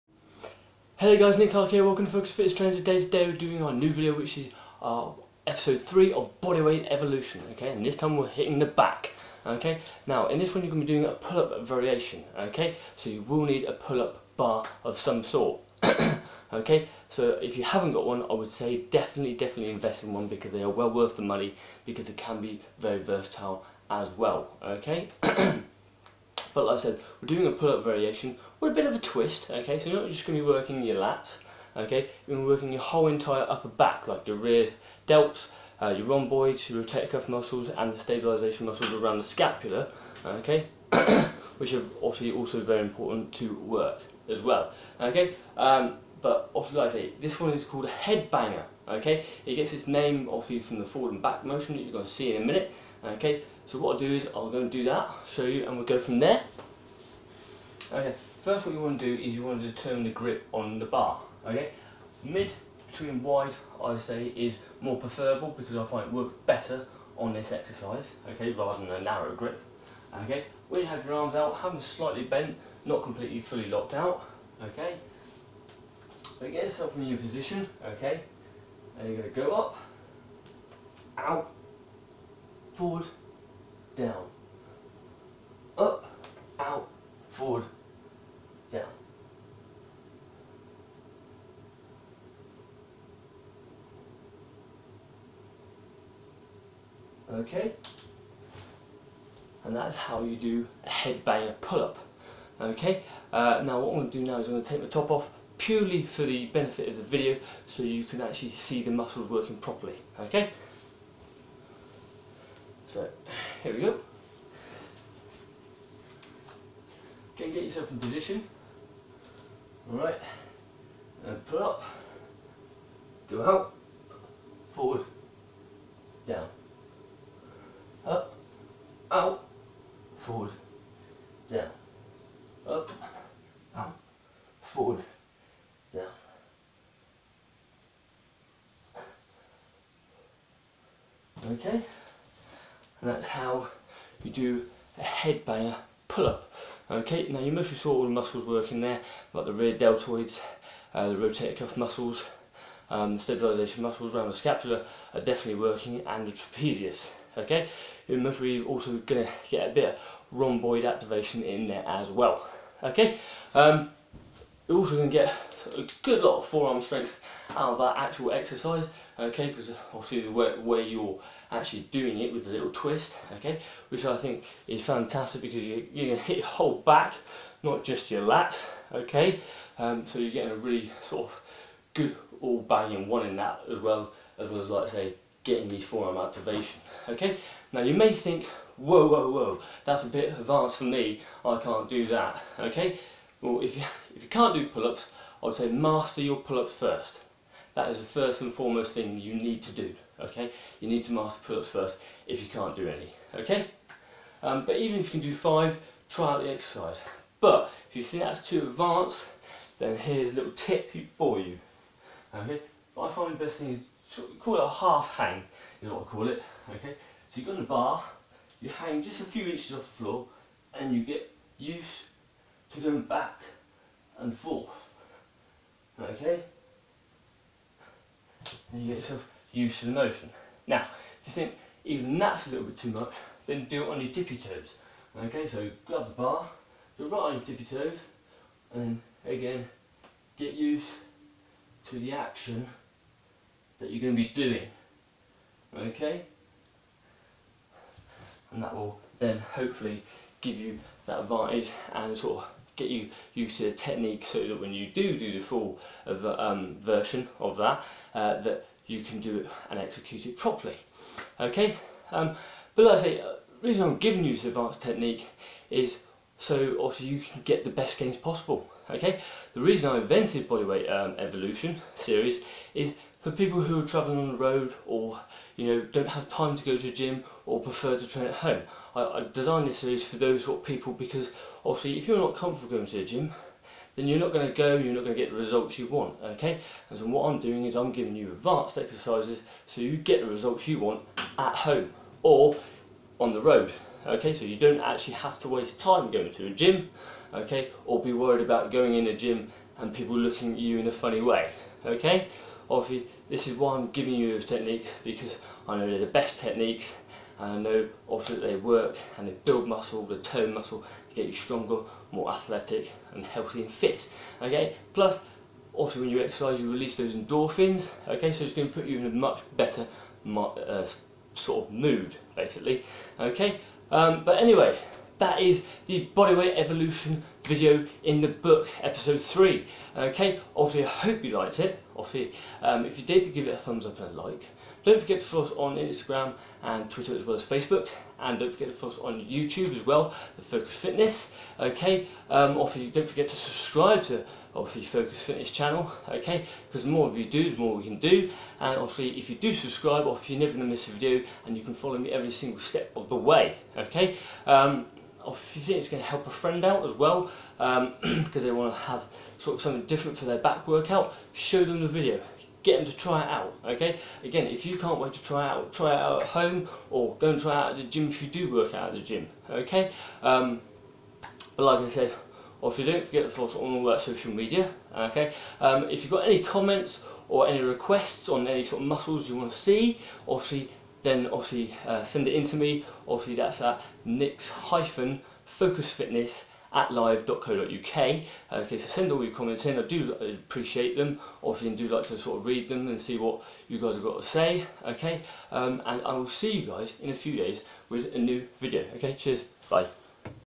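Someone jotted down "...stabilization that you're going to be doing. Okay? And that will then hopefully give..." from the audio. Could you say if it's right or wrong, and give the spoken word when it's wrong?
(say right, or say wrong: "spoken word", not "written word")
wrong: "action", not "stabilization".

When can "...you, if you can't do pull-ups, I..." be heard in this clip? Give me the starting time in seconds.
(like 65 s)
193 s.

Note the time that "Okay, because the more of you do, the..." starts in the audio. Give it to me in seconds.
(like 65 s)
346 s.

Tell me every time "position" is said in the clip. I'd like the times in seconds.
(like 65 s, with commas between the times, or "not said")
77 s, 117 s.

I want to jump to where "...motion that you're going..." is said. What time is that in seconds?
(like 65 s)
51 s.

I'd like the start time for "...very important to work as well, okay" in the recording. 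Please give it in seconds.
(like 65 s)
42 s.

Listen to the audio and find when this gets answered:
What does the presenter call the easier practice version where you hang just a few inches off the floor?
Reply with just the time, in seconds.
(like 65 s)
214 s.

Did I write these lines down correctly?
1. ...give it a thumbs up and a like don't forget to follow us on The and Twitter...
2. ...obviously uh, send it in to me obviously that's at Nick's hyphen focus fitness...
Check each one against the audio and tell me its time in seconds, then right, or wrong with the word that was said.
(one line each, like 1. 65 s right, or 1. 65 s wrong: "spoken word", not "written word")
1. 333 s wrong: "Instagram", not "The"
2. 381 s right.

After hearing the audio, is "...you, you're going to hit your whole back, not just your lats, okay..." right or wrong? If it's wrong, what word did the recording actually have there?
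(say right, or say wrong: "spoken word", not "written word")
right.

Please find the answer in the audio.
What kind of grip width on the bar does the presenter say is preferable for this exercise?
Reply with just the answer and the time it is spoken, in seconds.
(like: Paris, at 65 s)
Mid between wide, at 62 s.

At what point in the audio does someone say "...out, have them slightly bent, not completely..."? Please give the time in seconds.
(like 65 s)
71 s.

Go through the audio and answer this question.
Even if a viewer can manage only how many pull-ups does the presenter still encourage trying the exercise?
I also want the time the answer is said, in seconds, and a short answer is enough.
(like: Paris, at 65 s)
5, at 205 s.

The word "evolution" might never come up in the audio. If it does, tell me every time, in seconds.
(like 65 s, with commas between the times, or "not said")
6 s, 271 s, 326 s.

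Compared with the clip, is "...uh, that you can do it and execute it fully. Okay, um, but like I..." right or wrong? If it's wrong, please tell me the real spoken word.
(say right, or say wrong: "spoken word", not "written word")
wrong: "properly", not "fully".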